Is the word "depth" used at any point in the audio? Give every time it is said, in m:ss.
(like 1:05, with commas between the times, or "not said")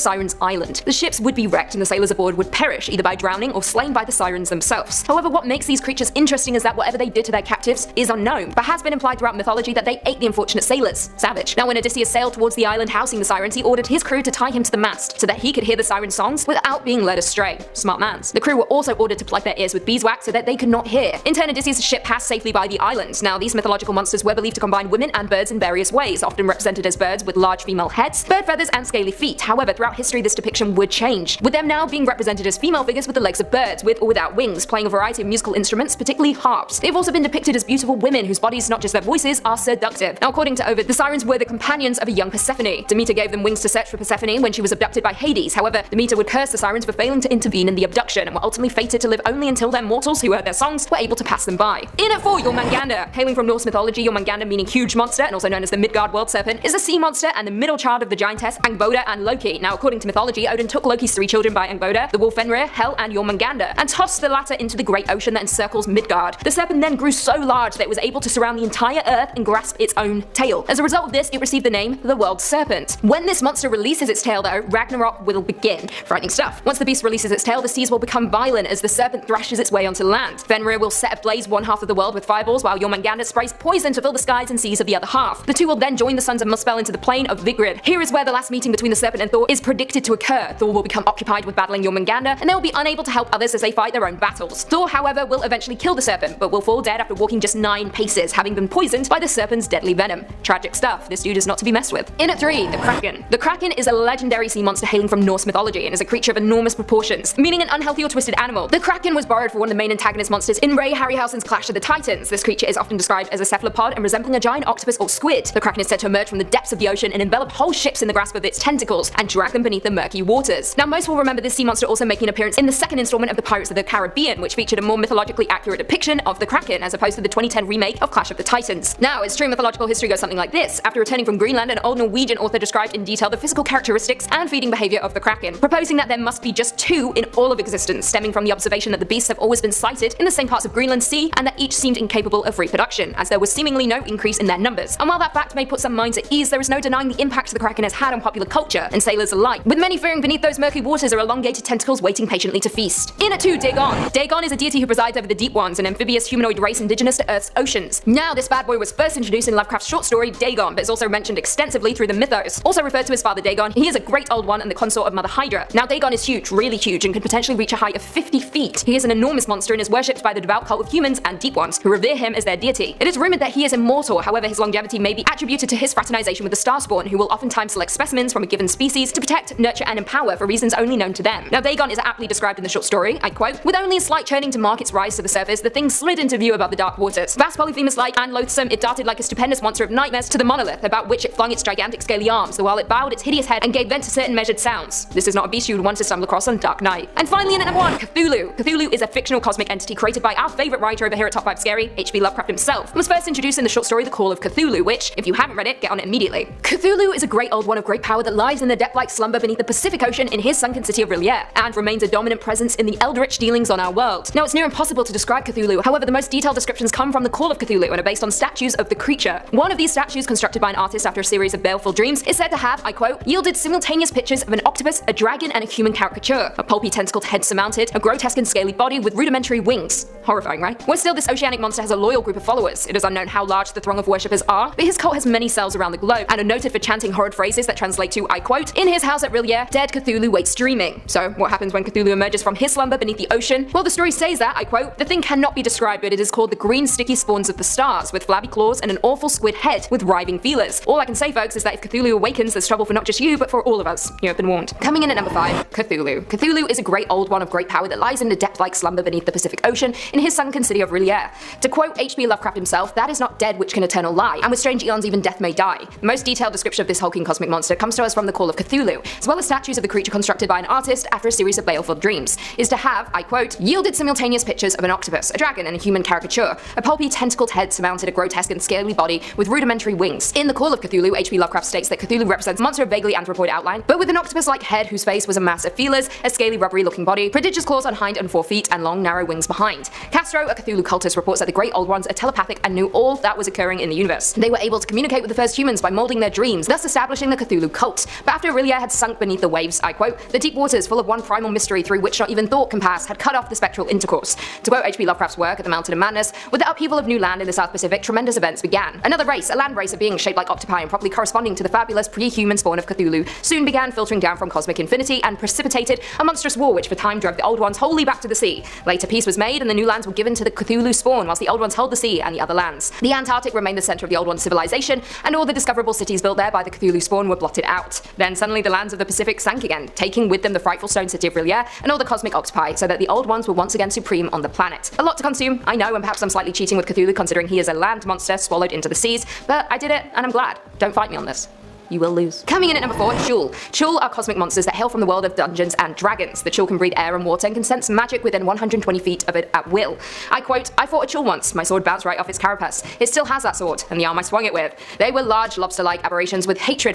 1:56, 3:28, 4:18.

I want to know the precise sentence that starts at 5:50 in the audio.
I quote, I fought a Chuul once, my sword bounced right off its carapace.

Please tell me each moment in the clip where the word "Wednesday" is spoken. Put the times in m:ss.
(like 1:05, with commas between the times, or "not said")
not said.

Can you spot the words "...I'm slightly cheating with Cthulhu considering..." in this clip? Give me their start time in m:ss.
5:36.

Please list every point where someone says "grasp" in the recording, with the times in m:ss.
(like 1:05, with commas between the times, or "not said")
1:09, 1:58.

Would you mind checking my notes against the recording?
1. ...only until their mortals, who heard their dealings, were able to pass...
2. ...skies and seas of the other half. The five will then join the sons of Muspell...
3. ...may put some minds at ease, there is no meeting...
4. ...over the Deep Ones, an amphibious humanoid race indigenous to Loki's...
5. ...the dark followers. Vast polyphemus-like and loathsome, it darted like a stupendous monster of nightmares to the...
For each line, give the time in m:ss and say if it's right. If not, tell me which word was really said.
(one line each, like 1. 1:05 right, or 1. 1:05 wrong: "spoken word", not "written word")
1. 0:49 wrong: "songs", not "dealings"
2. 1:24 wrong: "two", not "five"
3. 2:25 wrong: "denying", not "meeting"
4. 2:35 wrong: "Earth", not "Loki"
5. 3:06 wrong: "waters", not "followers".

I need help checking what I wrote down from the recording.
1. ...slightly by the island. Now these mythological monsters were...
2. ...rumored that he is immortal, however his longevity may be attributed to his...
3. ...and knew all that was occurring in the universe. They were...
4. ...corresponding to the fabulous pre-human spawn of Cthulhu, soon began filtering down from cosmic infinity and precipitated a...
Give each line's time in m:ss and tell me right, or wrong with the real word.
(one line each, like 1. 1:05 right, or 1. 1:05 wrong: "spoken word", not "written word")
1. 0:22 wrong: "safely", not "slightly"
2. 2:53 right
3. 4:52 right
4. 5:11 right.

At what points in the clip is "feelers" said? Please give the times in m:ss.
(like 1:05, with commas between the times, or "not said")
4:10, 4:45.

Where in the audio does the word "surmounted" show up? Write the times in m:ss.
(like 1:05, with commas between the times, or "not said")
3:47, 4:37.